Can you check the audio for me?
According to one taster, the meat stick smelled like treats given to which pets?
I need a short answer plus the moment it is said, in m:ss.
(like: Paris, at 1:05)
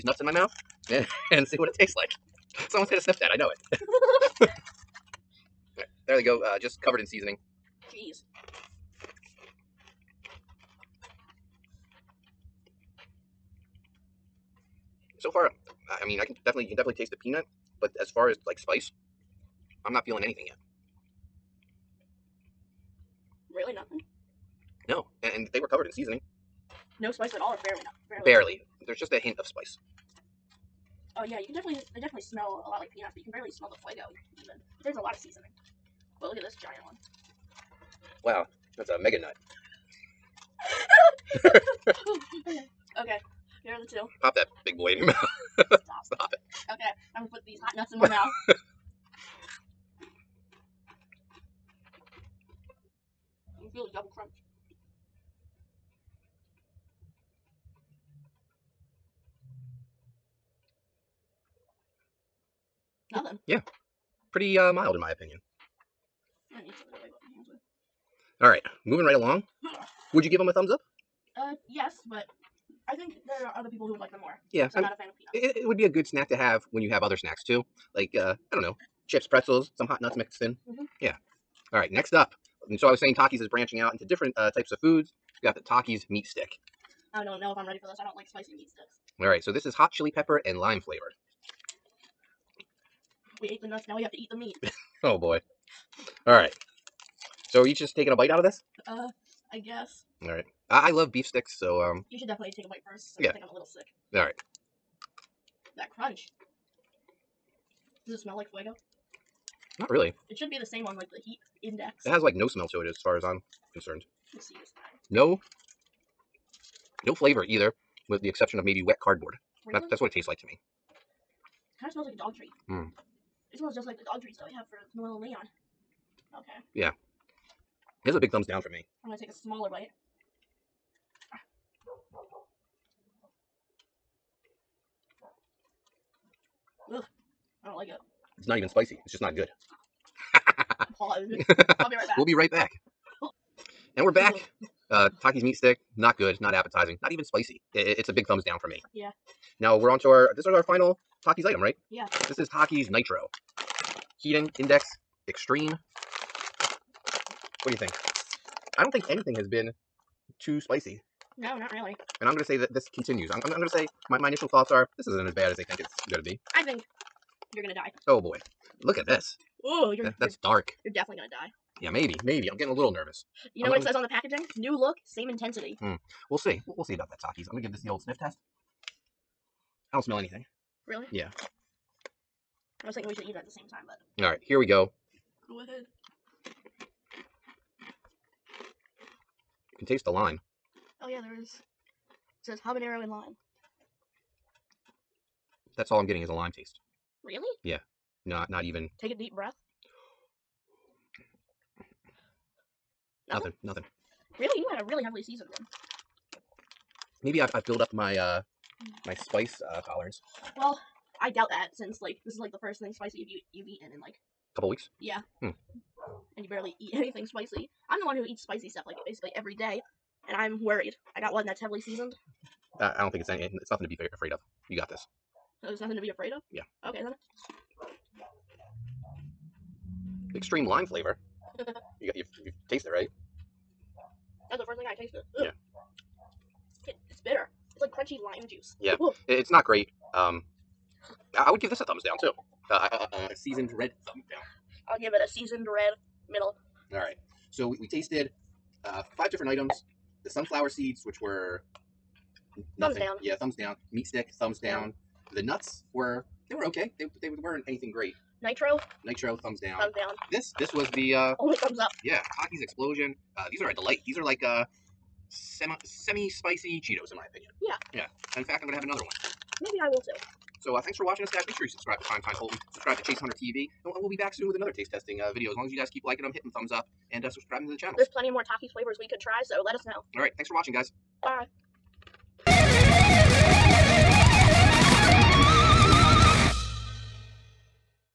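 Noel and Leon, at 2:04.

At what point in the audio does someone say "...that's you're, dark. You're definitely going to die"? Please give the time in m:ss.
2:50.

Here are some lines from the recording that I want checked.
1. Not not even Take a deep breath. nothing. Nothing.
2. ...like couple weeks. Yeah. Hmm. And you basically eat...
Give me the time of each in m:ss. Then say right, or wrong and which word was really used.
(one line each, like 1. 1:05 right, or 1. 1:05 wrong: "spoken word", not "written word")
1. 3:18 right
2. 3:34 wrong: "barely", not "basically".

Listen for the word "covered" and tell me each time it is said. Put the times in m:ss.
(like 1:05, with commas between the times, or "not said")
0:06, 0:25.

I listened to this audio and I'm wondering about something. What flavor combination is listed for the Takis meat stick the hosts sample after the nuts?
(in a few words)
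Hot chili pepper and lime.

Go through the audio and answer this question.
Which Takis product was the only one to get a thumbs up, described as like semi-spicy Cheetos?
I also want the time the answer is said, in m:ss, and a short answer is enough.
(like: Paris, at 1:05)
Takis Xplosion, at 4:22.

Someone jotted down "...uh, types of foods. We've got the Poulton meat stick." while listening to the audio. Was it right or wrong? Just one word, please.
wrong.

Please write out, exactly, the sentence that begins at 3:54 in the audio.
That's the first thing I tasted.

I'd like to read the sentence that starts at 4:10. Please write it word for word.
The sunflower seeds, which were nothing.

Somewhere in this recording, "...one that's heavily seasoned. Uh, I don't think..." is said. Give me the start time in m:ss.
3:41.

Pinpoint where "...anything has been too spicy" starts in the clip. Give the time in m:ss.
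2:39.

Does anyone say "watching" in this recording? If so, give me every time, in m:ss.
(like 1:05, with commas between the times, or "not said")
4:31, 4:40.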